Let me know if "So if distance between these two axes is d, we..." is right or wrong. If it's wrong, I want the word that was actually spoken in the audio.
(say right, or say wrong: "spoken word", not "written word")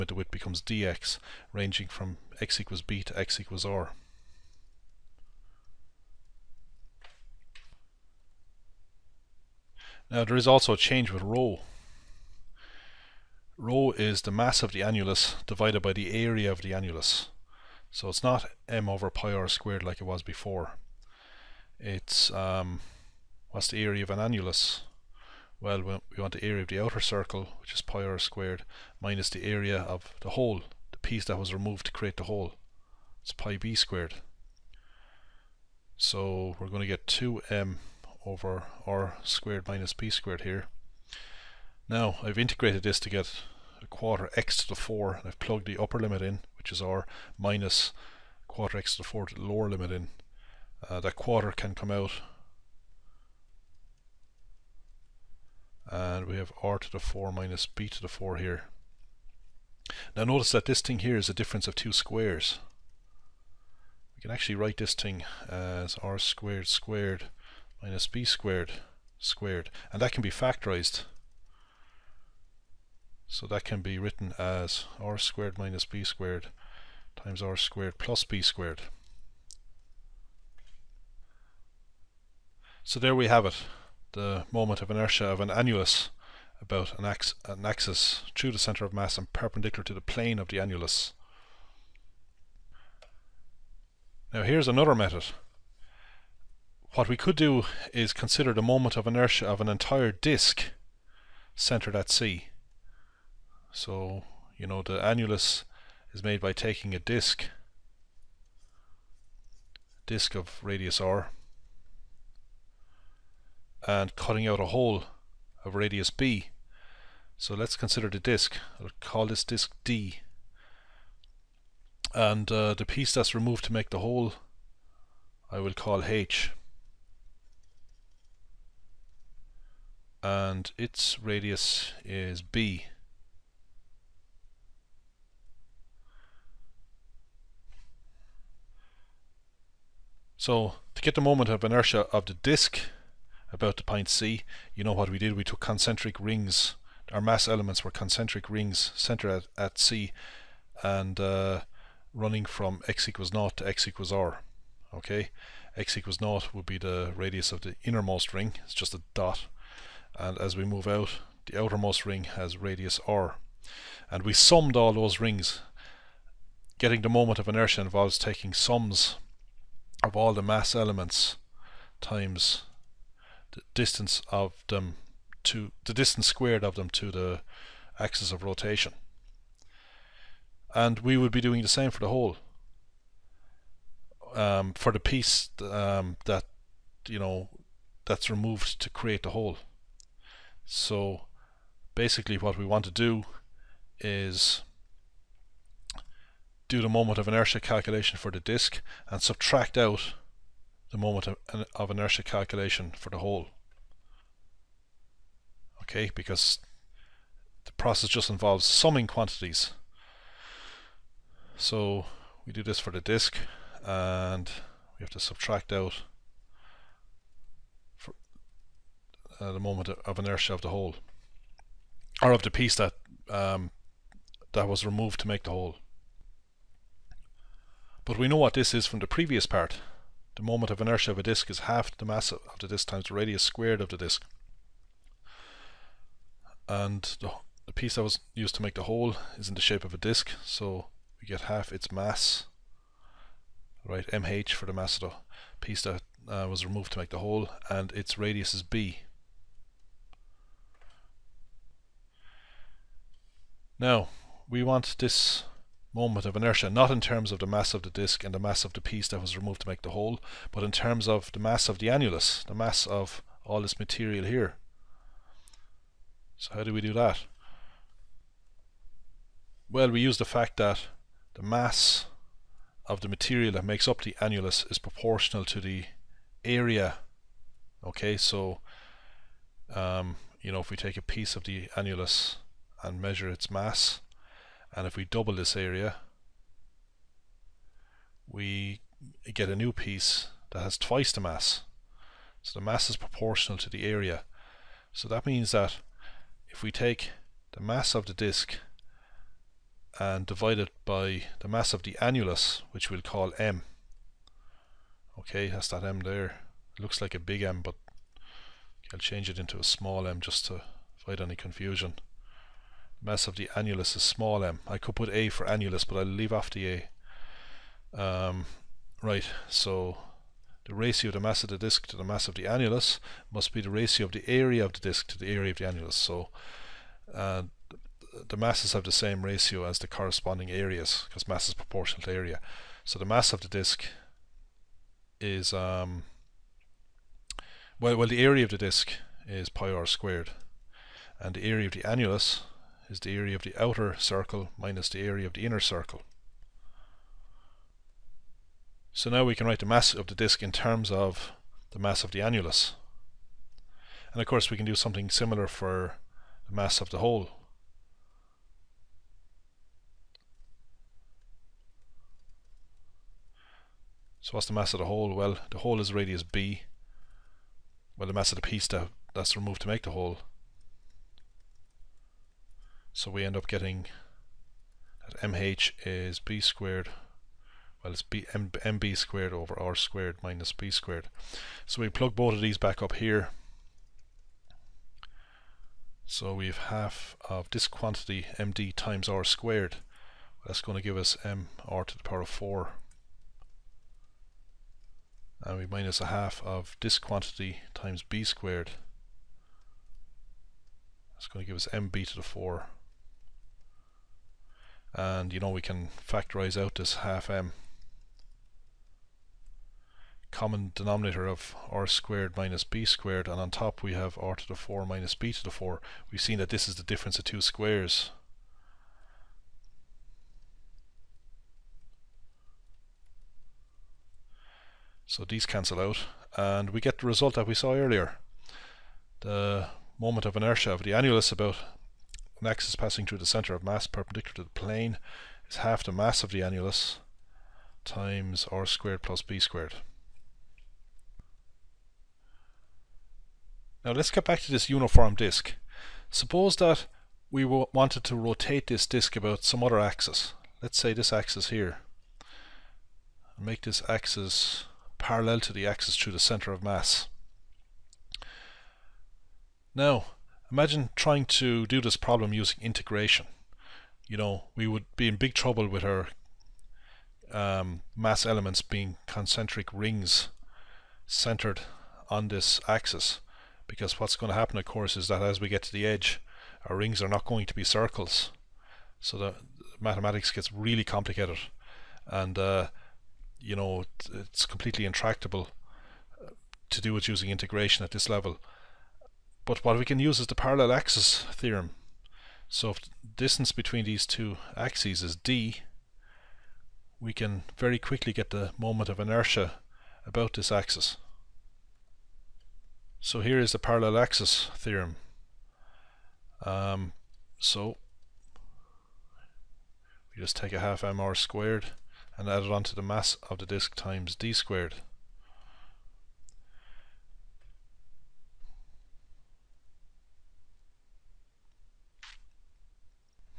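right.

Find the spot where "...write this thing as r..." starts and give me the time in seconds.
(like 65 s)
64 s.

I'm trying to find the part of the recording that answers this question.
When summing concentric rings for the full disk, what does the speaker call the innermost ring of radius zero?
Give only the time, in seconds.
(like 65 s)
158 s.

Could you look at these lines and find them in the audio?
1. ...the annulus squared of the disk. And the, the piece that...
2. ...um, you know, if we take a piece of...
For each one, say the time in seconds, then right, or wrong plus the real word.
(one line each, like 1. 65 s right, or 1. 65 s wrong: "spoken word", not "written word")
1. 233 s wrong: "radius", not "annulus"
2. 279 s right.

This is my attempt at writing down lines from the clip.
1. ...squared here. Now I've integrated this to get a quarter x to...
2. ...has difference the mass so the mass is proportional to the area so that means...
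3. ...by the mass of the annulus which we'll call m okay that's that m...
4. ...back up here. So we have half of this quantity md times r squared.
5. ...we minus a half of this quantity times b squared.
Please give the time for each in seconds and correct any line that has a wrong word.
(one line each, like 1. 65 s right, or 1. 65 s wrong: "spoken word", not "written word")
1. 40 s right
2. 290 s wrong: "twice", not "difference"
3. 300 s right
4. 382 s right
5. 395 s right.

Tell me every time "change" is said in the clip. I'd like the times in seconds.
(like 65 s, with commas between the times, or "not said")
10 s, 308 s.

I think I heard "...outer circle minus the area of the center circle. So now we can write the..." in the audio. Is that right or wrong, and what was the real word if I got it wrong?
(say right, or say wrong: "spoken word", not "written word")
wrong: "inner", not "center".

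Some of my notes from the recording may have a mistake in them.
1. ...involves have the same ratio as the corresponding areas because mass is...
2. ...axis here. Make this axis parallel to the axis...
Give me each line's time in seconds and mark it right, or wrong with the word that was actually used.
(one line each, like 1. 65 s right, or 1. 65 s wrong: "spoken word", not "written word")
1. 328 s wrong: "masses", not "involves"
2. 451 s right.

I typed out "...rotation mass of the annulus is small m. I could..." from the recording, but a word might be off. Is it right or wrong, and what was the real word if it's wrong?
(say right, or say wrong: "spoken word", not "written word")
wrong: "confusion", not "rotation".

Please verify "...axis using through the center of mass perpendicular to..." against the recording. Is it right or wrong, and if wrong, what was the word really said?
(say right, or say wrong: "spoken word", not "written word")
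wrong: "passing", not "using".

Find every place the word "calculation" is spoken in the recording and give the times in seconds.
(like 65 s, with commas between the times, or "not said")
197 s, 202 s.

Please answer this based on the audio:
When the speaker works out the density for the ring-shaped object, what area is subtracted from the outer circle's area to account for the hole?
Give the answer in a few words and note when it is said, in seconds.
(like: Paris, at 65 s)
pi b squared, at 33 s.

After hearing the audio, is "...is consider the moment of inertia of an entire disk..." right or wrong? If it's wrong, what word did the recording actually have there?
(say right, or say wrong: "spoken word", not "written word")
right.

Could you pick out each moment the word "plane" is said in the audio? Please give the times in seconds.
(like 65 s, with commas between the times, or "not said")
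90 s, 434 s.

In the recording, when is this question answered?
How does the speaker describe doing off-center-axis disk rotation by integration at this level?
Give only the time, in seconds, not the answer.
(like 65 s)
484 s.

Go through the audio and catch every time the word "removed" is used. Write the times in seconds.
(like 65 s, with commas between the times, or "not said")
31 s, 123 s, 188 s, 224 s, 246 s, 259 s, 369 s.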